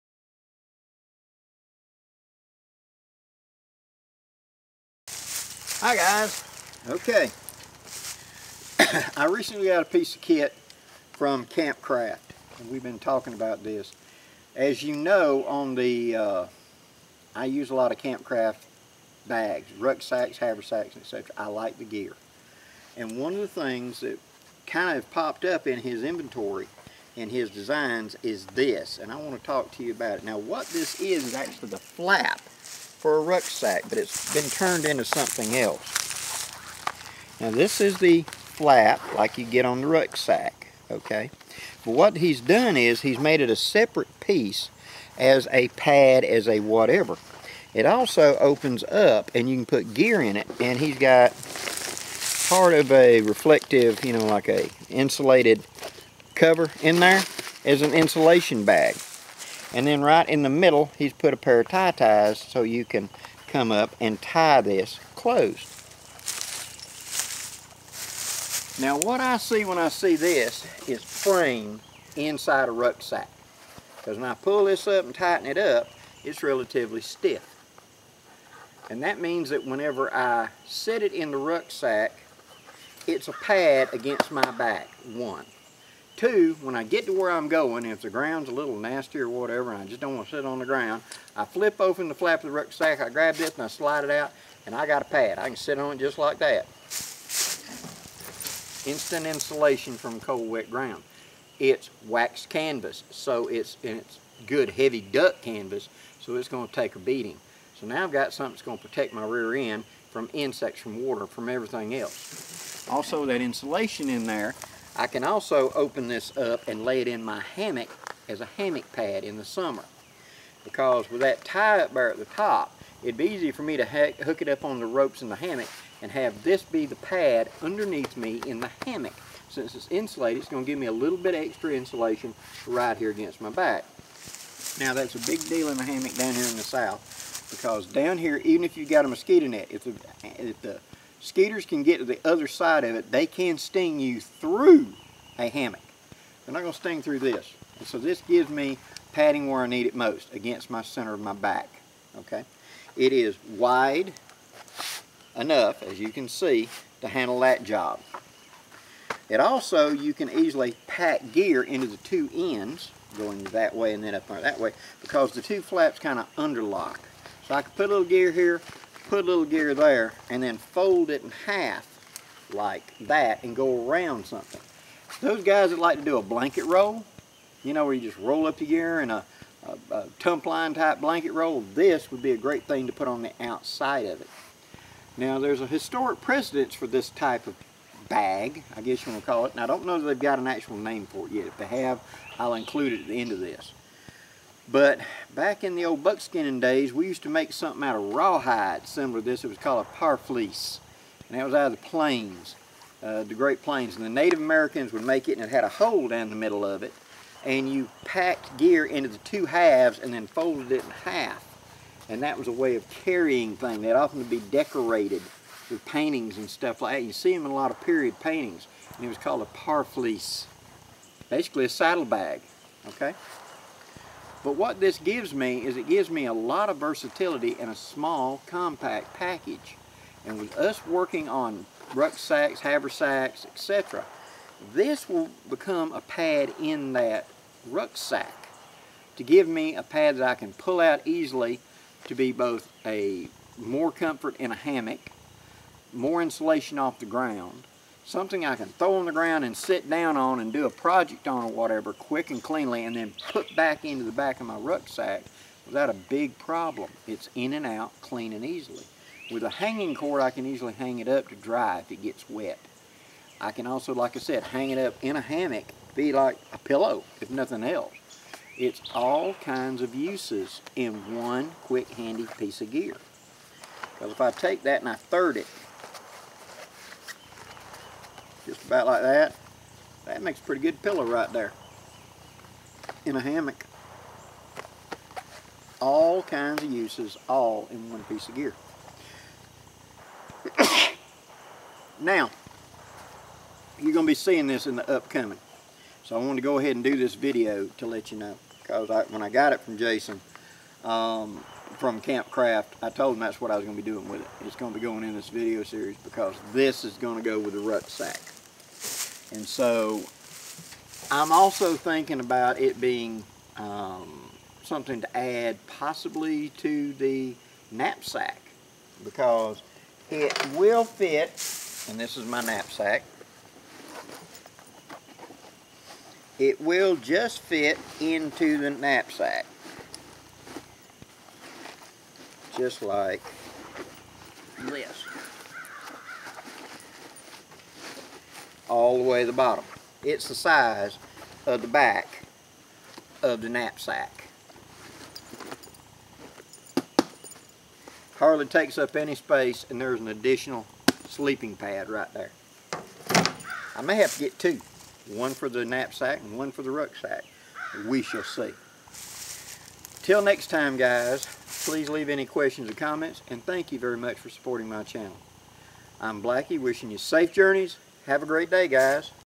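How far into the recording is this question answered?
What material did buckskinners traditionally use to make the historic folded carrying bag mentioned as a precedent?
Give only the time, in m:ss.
3:18.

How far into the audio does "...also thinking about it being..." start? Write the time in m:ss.
5:11.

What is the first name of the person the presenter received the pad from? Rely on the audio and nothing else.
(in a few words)
Jason.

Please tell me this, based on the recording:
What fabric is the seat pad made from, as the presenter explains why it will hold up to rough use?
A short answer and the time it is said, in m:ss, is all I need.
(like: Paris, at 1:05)
Wax canvas, at 1:42.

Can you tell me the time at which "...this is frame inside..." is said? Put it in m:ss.
1:10.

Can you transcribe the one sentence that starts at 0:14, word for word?
As you know on the, uh, I use a lot of Campcraft bags, rucksacks, haversacks, etc.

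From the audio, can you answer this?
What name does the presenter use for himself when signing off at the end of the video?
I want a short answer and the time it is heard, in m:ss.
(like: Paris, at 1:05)
Blackie, at 6:06.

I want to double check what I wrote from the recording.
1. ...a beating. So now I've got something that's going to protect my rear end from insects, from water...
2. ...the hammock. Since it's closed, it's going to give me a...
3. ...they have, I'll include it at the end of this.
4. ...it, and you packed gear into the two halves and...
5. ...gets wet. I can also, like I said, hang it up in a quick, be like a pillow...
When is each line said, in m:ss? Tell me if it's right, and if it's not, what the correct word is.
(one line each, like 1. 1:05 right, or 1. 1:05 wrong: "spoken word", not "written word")
1. 1:46 right
2. 2:08 wrong: "insulated", not "closed"
3. 3:11 right
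4. 3:26 right
5. 4:22 wrong: "hammock", not "quick".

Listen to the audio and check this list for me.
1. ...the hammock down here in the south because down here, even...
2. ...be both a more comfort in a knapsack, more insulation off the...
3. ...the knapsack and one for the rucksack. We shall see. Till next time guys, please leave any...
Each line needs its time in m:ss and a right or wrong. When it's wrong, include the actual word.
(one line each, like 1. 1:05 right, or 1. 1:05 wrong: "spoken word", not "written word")
1. 2:15 right
2. 4:02 wrong: "hammock", not "knapsack"
3. 5:55 right.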